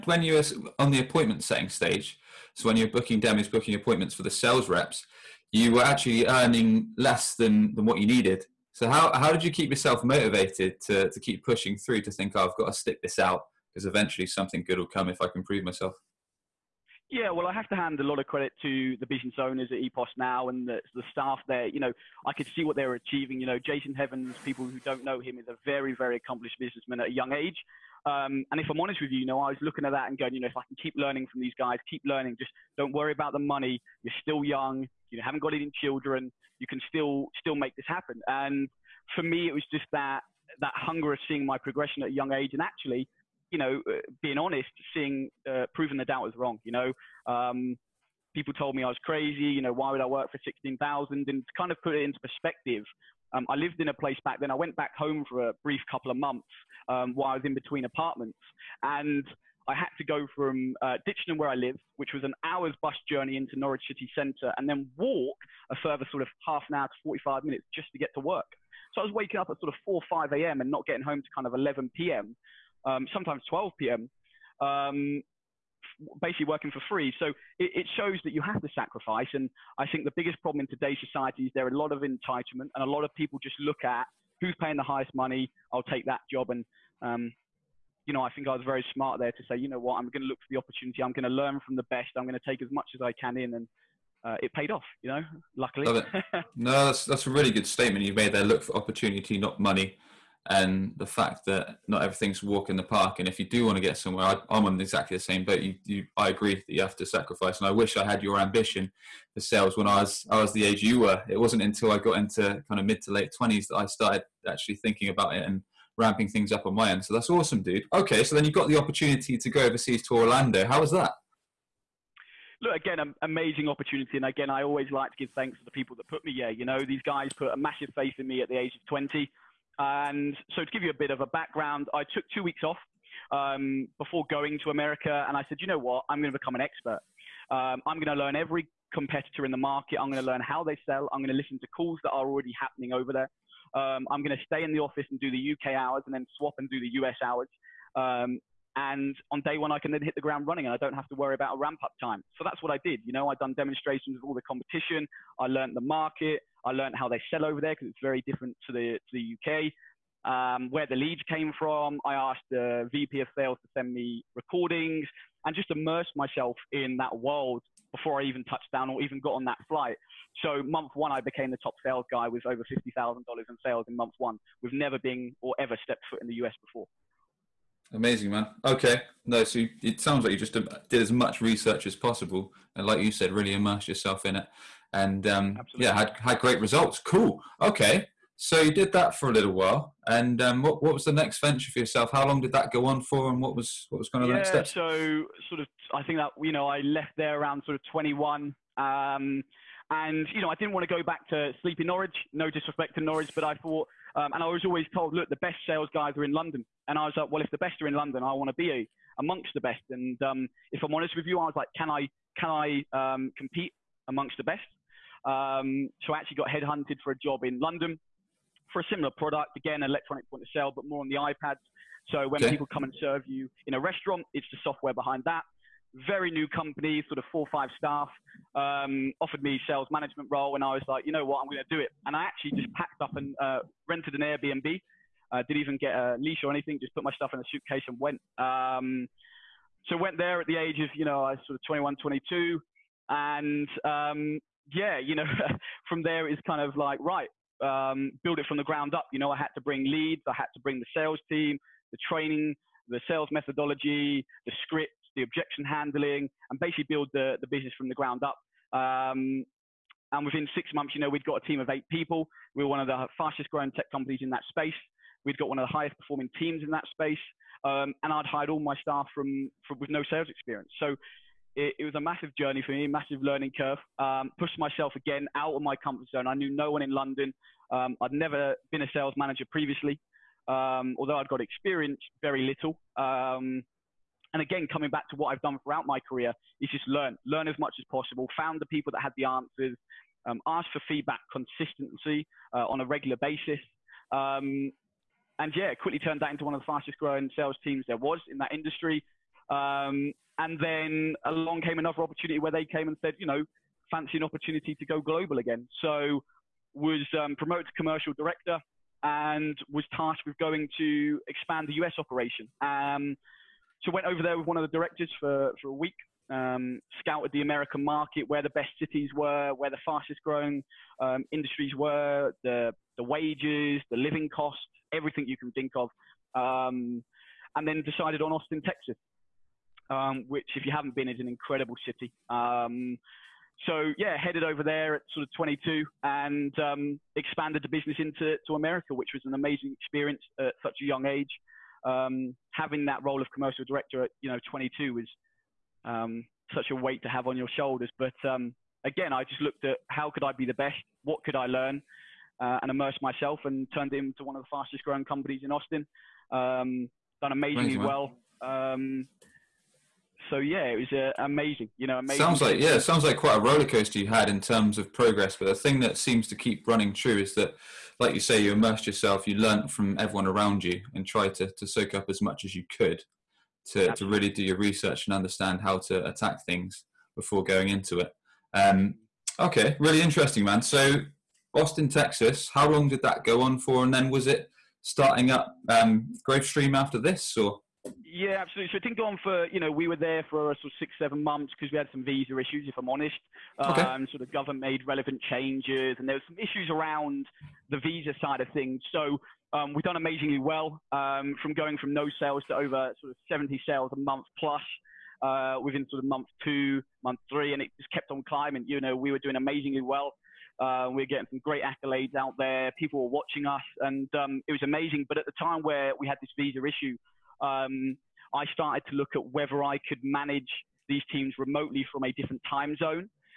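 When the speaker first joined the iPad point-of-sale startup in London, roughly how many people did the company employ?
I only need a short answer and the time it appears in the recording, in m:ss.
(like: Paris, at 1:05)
4 or 5, at 3:47.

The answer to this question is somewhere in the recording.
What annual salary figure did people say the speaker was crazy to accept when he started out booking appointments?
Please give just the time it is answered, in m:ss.
0:50.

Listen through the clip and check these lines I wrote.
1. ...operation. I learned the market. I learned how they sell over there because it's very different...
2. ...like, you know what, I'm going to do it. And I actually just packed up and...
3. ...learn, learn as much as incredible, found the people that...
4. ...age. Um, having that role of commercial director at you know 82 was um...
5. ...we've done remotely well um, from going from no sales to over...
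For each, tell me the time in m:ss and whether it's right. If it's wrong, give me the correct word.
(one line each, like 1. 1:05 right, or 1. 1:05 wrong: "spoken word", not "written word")
1. 2:34 wrong: "competition", not "operation"
2. 3:50 right
3. 4:46 wrong: "possible", not "incredible"
4. 5:41 wrong: "22", not "82"
5. 6:39 wrong: "amazingly", not "remotely".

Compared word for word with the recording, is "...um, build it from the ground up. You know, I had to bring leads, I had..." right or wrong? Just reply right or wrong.
right.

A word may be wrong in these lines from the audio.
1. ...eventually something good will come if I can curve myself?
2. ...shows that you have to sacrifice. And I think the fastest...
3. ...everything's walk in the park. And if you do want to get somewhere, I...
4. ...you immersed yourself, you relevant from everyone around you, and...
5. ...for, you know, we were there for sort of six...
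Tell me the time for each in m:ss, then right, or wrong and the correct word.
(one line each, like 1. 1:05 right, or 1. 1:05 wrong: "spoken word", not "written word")
1. 0:13 wrong: "prove", not "curve"
2. 1:17 wrong: "biggest", not "fastest"
3. 1:42 right
4. 6:08 wrong: "learnt", not "relevant"
5. 6:29 right.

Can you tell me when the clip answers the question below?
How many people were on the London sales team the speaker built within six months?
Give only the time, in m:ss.
4:21.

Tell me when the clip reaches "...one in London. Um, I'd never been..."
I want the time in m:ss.
4:36.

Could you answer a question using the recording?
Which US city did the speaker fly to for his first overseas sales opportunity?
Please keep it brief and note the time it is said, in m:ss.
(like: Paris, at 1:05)
Orlando, at 2:00.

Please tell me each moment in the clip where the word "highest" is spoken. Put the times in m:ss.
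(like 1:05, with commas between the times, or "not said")
1:24, 4:25.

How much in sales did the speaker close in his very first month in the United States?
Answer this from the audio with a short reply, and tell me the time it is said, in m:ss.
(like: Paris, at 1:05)
$50,000, at 2:52.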